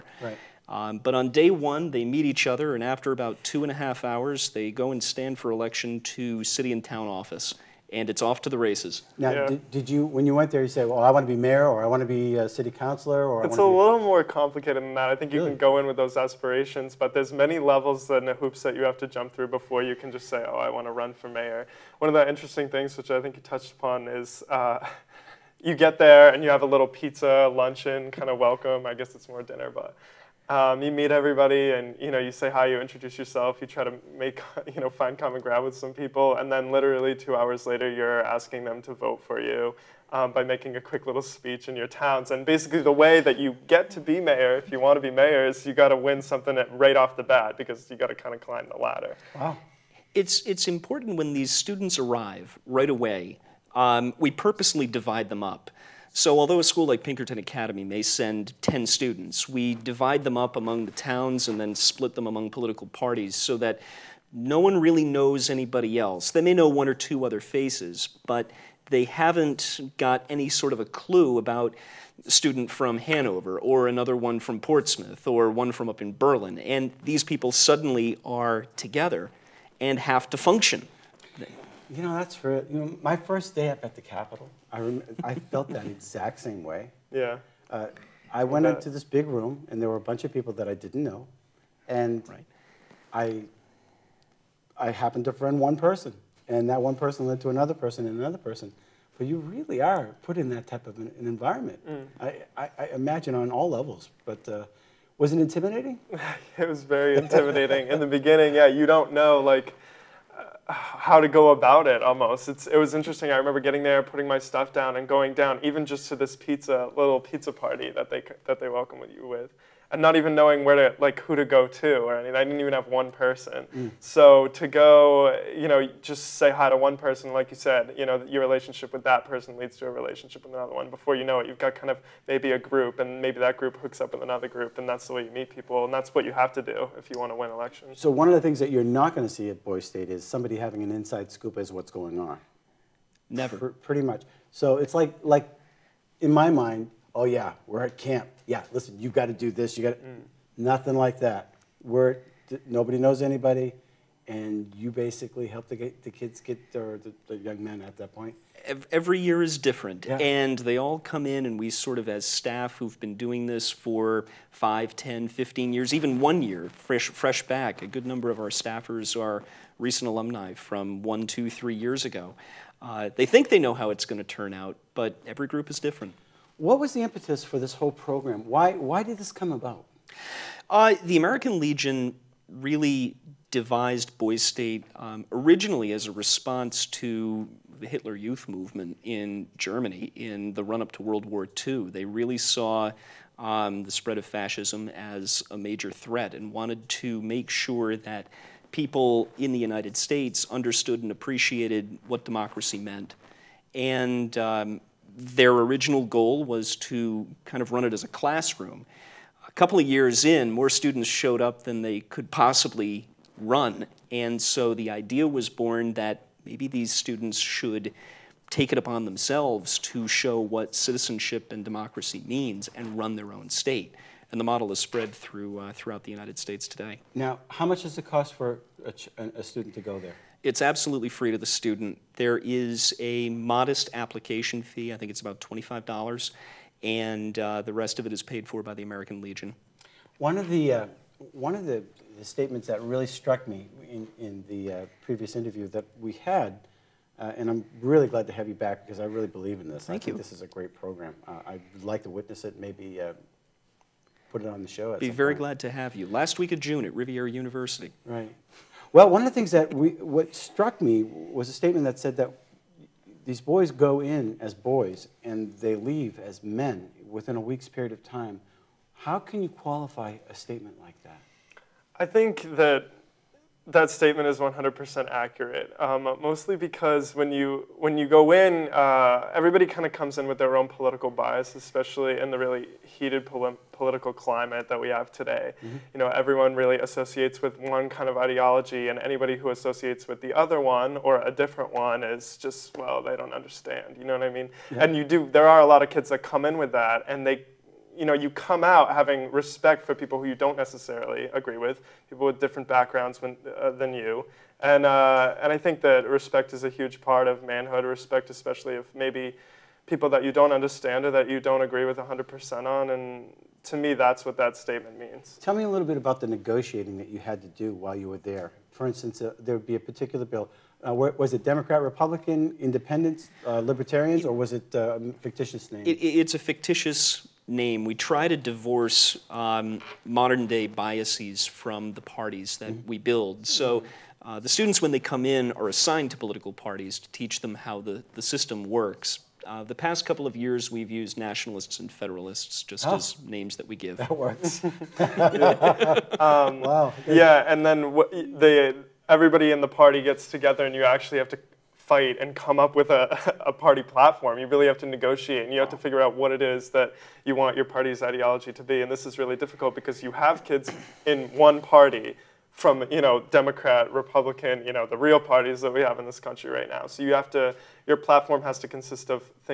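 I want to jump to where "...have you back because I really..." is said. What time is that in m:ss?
4:08.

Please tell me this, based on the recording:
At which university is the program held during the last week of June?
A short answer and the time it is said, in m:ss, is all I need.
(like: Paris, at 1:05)
Rivier University, at 4:16.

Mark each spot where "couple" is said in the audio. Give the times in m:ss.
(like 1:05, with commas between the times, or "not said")
3:29, 5:40.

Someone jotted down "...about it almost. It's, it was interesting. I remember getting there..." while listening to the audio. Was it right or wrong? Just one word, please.
right.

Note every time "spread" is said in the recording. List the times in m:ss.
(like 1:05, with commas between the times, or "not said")
3:13, 3:44.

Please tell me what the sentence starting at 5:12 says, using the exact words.
And to me, that's what that statement means.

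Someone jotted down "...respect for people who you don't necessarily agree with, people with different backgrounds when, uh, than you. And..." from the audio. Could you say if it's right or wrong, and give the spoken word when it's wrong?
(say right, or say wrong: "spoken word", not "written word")
right.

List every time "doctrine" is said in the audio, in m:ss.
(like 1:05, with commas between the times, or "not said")
not said.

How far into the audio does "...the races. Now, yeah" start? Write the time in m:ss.
0:08.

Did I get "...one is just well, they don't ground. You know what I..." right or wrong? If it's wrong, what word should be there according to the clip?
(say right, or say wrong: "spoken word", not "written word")
wrong: "understand", not "ground".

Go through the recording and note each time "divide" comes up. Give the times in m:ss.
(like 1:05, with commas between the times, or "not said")
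0:54, 0:59.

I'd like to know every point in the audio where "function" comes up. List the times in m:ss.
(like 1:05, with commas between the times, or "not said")
1:20.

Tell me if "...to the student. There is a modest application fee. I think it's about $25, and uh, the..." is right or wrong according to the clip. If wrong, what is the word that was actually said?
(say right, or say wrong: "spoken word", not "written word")
right.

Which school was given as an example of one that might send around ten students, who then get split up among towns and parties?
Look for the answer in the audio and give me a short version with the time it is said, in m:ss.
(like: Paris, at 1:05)
Pinkerton Academy, at 0:57.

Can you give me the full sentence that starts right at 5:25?
It, it's a fictitious name, we try to divorce um, modern day biases from the parties that mm-hmm.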